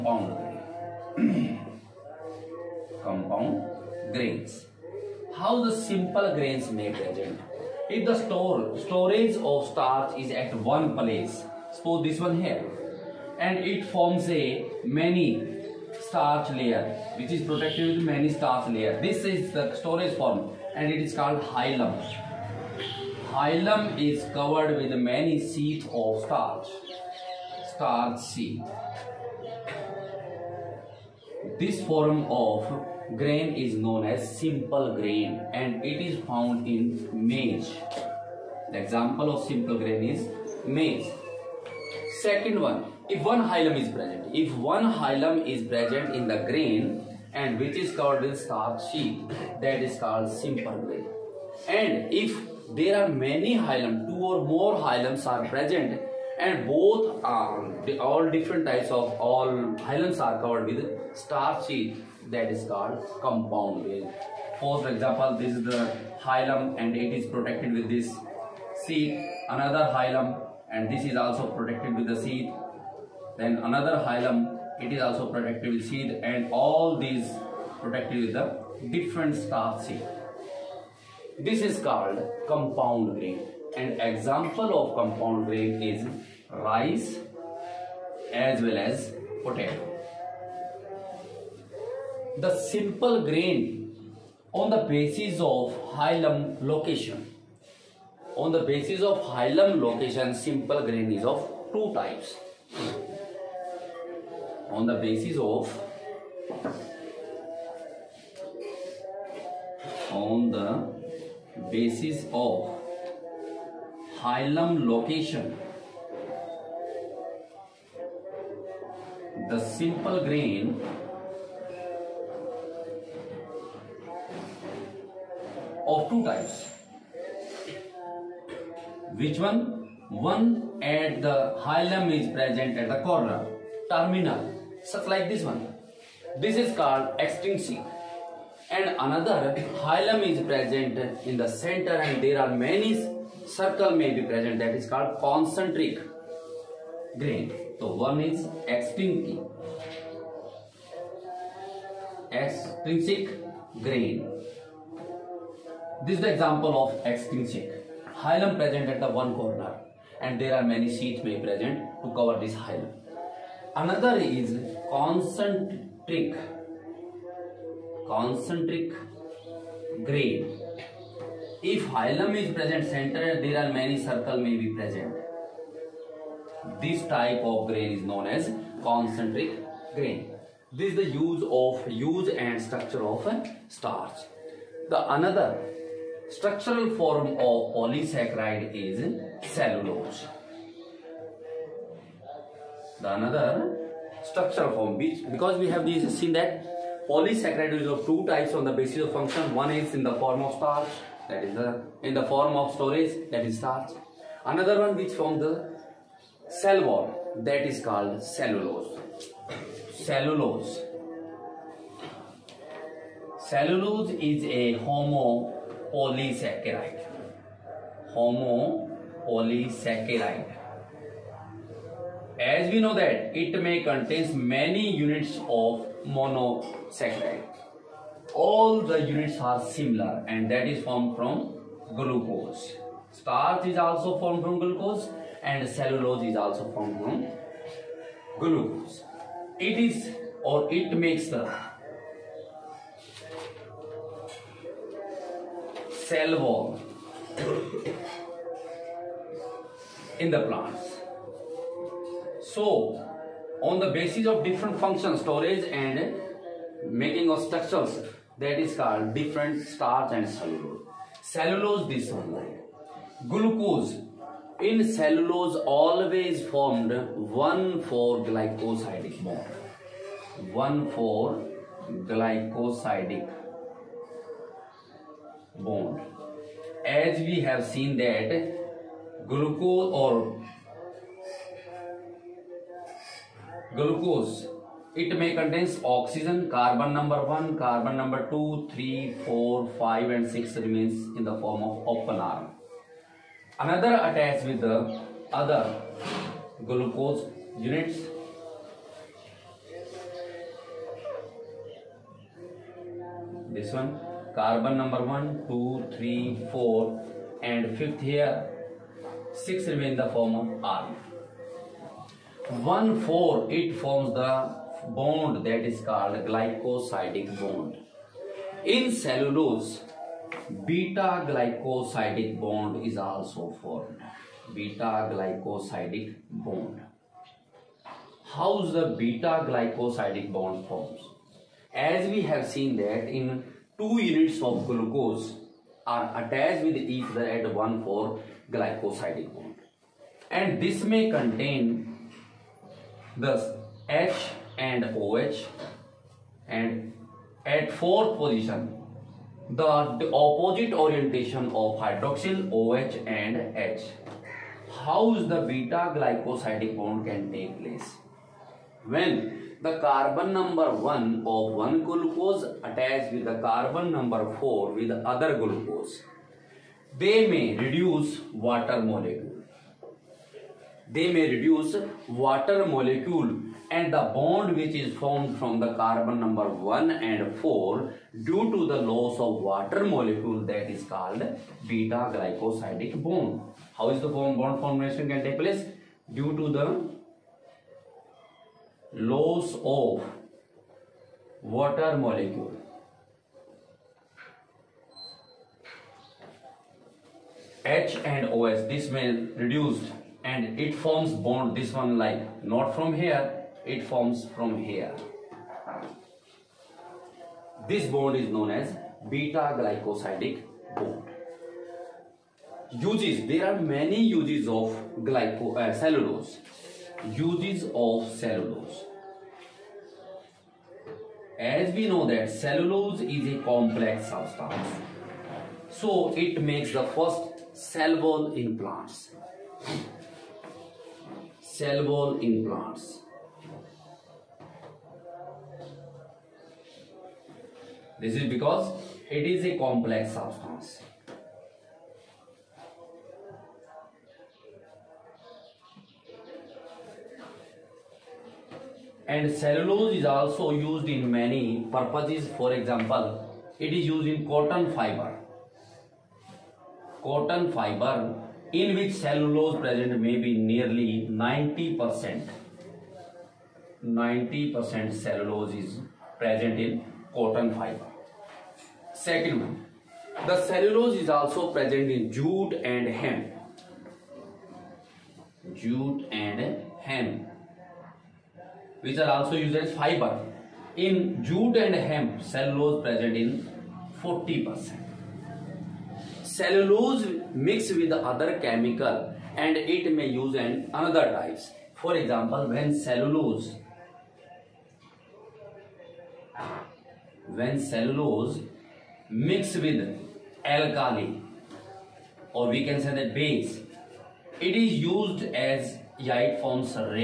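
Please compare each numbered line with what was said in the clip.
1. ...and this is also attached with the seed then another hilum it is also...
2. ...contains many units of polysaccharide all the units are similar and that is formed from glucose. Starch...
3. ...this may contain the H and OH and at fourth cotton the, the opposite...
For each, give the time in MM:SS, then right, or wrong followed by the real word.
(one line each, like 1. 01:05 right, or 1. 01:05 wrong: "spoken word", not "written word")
1. 01:10 wrong: "protected", not "attached"
2. 03:43 wrong: "monosaccharide", not "polysaccharide"
3. 05:40 wrong: "position", not "cotton".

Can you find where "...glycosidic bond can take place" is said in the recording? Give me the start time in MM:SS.
05:55.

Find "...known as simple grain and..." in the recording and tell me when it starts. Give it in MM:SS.
00:33.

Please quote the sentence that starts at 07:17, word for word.
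This is because it is a complex substance.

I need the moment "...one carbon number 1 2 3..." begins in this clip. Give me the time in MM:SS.
05:03.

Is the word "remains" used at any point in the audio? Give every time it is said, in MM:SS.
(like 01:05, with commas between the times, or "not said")
04:50, 05:09.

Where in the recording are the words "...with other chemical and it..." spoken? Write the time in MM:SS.
08:07.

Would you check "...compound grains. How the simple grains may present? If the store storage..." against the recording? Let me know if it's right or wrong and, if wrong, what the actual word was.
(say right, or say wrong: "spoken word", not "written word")
right.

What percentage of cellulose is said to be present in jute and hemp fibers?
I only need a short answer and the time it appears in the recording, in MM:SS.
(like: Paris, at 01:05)
40%, at 08:04.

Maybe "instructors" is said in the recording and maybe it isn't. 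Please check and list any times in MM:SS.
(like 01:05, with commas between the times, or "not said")
not said.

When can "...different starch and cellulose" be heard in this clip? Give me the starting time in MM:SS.
04:19.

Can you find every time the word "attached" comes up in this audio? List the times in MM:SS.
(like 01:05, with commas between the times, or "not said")
04:53, 05:36, 06:02.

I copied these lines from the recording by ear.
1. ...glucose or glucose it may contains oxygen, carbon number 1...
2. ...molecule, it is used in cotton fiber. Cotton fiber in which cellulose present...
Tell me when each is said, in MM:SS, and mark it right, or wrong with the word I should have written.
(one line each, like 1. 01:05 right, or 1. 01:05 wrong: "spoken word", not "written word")
1. 04:39 right
2. 07:32 wrong: "example", not "molecule".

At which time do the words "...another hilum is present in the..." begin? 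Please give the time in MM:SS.
02:18.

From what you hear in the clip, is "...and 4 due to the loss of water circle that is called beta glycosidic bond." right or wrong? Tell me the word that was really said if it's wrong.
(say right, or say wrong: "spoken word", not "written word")
wrong: "molecule", not "circle".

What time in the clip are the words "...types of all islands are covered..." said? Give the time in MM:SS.
00:58.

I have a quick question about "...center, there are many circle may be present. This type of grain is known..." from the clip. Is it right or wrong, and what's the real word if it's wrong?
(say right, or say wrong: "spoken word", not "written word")
right.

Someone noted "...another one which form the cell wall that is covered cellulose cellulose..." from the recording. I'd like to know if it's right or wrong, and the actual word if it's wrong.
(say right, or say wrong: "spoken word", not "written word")
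wrong: "called", not "covered".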